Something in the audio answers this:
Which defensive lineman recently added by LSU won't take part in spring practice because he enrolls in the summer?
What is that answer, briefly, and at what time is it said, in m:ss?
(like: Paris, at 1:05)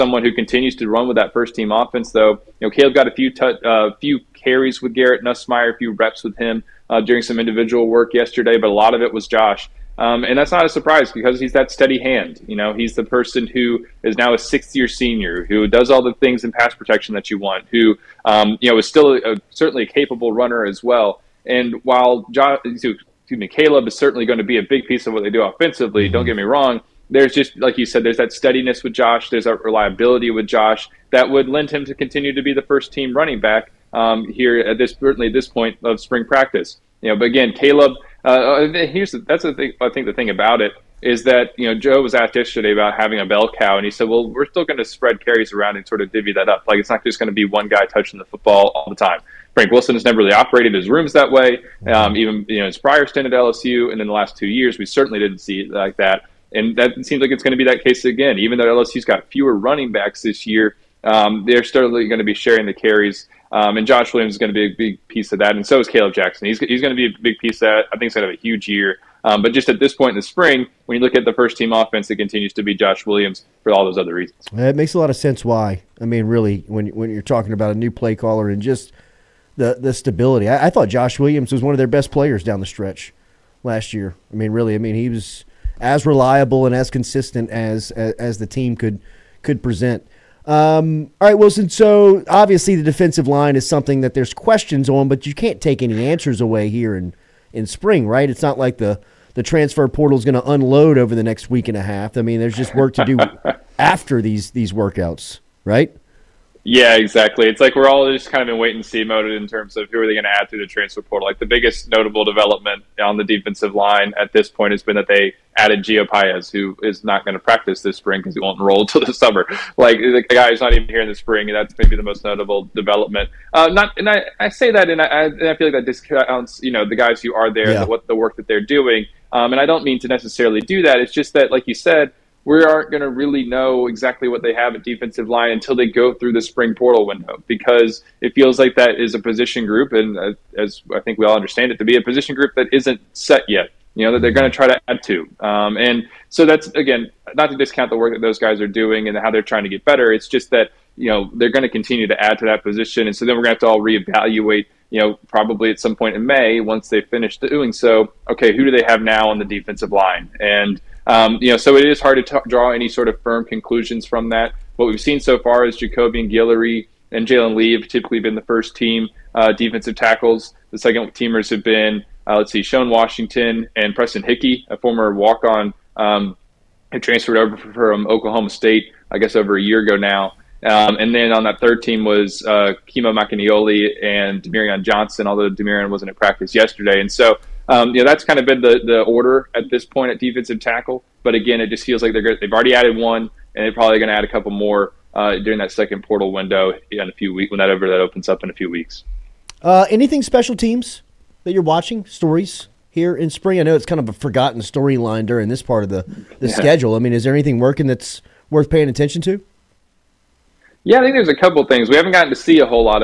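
Gio Paez, at 1:55.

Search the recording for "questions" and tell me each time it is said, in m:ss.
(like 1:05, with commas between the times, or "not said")
1:34.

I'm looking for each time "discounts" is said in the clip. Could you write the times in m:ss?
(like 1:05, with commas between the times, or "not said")
2:05, 2:27.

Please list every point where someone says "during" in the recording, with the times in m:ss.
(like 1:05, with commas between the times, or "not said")
0:07, 3:15, 3:25.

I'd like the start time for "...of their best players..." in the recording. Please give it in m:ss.
1:21.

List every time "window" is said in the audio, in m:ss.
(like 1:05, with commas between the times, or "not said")
2:17, 3:16.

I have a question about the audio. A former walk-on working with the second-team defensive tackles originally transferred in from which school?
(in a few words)
Oklahoma State.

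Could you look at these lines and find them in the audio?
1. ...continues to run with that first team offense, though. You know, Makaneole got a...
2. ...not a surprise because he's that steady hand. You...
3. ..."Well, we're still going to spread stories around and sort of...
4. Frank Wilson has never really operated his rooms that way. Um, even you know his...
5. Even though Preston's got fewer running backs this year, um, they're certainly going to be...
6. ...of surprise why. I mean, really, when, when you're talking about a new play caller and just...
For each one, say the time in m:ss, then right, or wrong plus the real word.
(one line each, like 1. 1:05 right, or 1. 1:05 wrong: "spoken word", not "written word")
1. 0:00 wrong: "Kaleb", not "Makaneole"
2. 0:10 right
3. 0:44 wrong: "carries", not "stories"
4. 0:49 right
5. 0:58 wrong: "LSU", not "Preston"
6. 1:15 wrong: "sense", not "surprise".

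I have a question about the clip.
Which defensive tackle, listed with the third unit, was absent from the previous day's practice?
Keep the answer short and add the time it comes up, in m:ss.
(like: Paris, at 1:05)
Demirion Johnson, at 3:04.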